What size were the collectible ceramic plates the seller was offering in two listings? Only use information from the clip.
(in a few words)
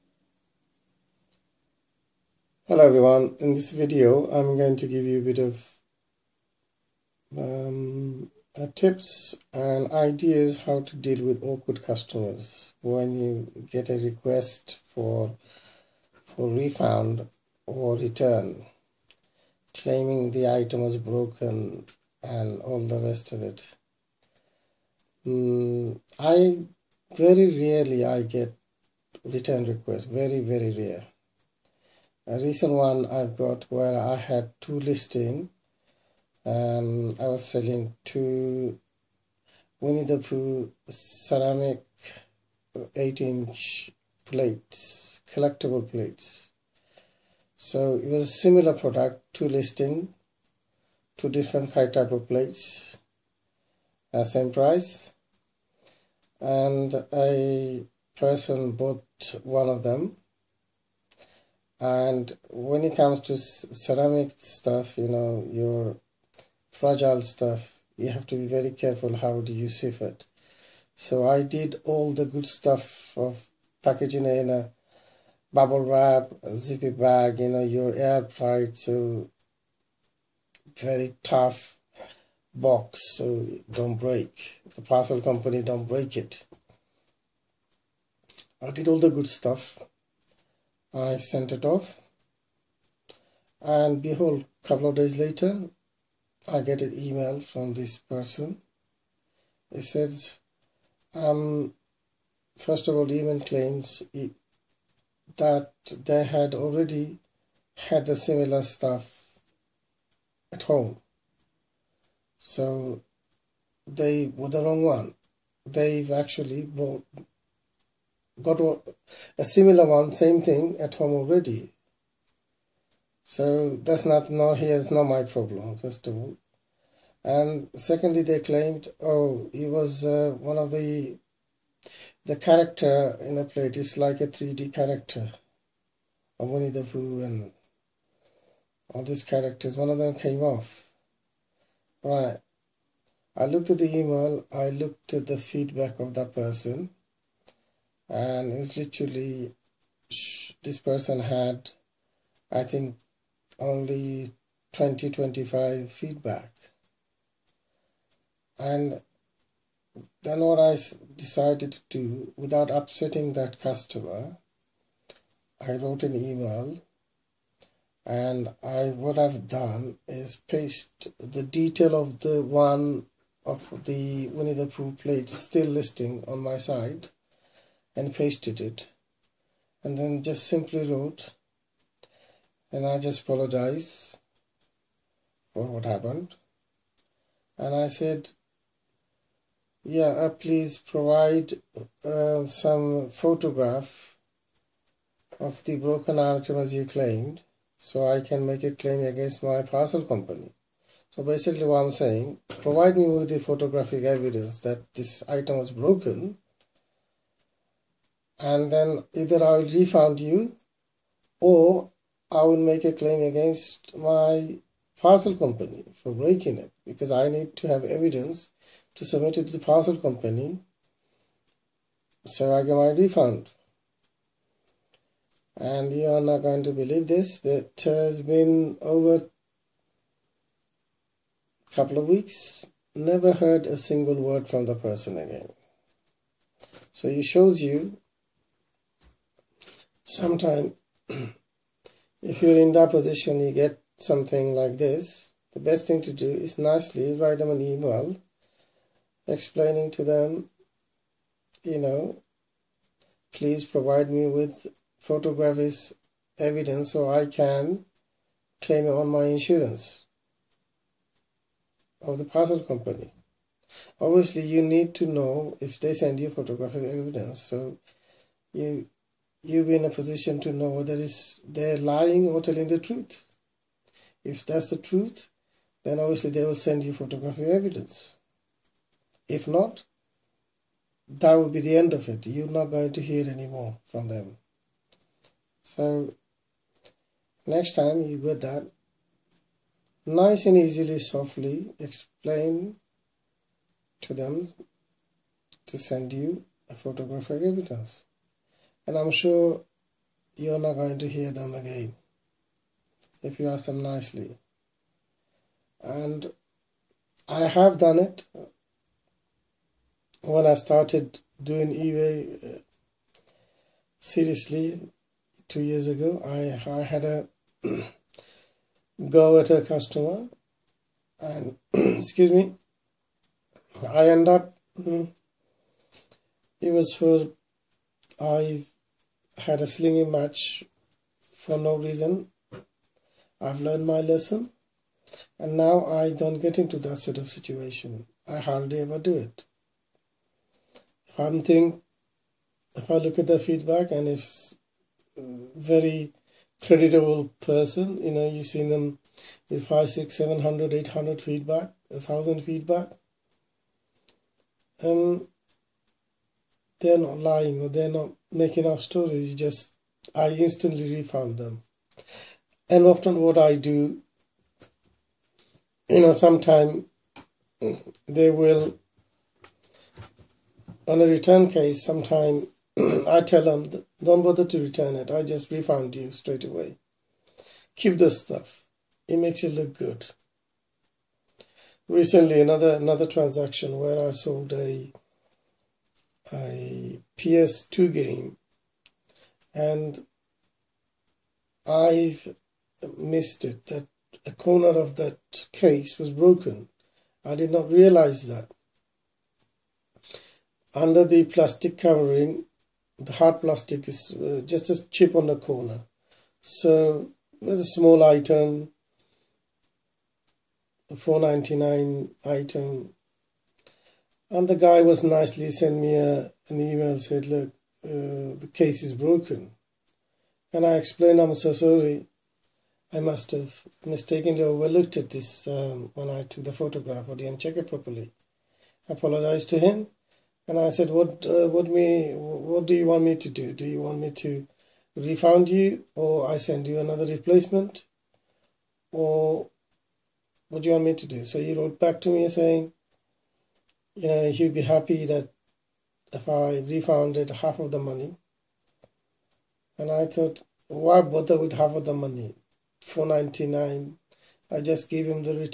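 8 inch.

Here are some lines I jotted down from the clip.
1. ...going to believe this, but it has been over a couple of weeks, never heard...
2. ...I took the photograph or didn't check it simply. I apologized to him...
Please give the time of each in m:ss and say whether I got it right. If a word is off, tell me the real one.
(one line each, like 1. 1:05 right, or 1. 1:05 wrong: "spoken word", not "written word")
1. 3:46 right
2. 7:06 wrong: "properly", not "simply".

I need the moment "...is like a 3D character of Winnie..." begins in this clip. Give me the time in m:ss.
2:13.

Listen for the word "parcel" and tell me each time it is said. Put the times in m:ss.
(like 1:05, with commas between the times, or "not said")
1:24, 3:19, 3:34, 3:39, 4:22.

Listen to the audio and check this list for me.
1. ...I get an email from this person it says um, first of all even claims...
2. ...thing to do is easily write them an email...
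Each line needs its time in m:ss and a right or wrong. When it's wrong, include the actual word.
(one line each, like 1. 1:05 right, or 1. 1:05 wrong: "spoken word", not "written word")
1. 1:36 right
2. 4:05 wrong: "nicely", not "easily".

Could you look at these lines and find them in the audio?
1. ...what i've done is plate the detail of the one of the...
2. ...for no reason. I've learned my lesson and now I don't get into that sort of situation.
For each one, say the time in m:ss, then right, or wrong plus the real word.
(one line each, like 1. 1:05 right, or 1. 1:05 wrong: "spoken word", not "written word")
1. 2:48 wrong: "paste", not "plate"
2. 5:31 right.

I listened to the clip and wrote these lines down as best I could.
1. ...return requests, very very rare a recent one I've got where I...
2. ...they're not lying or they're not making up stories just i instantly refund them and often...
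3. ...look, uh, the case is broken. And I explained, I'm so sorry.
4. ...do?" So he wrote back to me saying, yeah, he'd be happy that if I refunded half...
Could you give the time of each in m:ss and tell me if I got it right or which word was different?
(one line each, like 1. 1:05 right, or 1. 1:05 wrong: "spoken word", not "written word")
1. 0:29 right
2. 5:56 right
3. 6:57 right
4. 7:21 right.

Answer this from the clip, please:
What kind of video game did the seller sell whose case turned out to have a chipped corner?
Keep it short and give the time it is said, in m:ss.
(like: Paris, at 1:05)
PS2 game, at 6:27.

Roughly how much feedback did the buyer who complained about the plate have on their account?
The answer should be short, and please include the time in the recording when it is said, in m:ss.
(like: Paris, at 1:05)
20 25, at 2:34.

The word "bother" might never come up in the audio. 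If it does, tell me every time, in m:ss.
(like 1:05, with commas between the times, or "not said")
6:14, 7:31.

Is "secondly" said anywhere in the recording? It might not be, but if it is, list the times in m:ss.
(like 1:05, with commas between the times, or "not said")
2:07.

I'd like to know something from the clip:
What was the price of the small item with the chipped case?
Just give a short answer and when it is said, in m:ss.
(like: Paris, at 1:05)
4.99, at 6:50.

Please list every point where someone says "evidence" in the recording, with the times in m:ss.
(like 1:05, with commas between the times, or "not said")
3:24, 3:37, 4:16, 4:26, 4:37, 4:57.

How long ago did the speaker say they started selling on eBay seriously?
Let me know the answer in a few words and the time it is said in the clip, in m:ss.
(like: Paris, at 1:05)
two years ago, at 5:15.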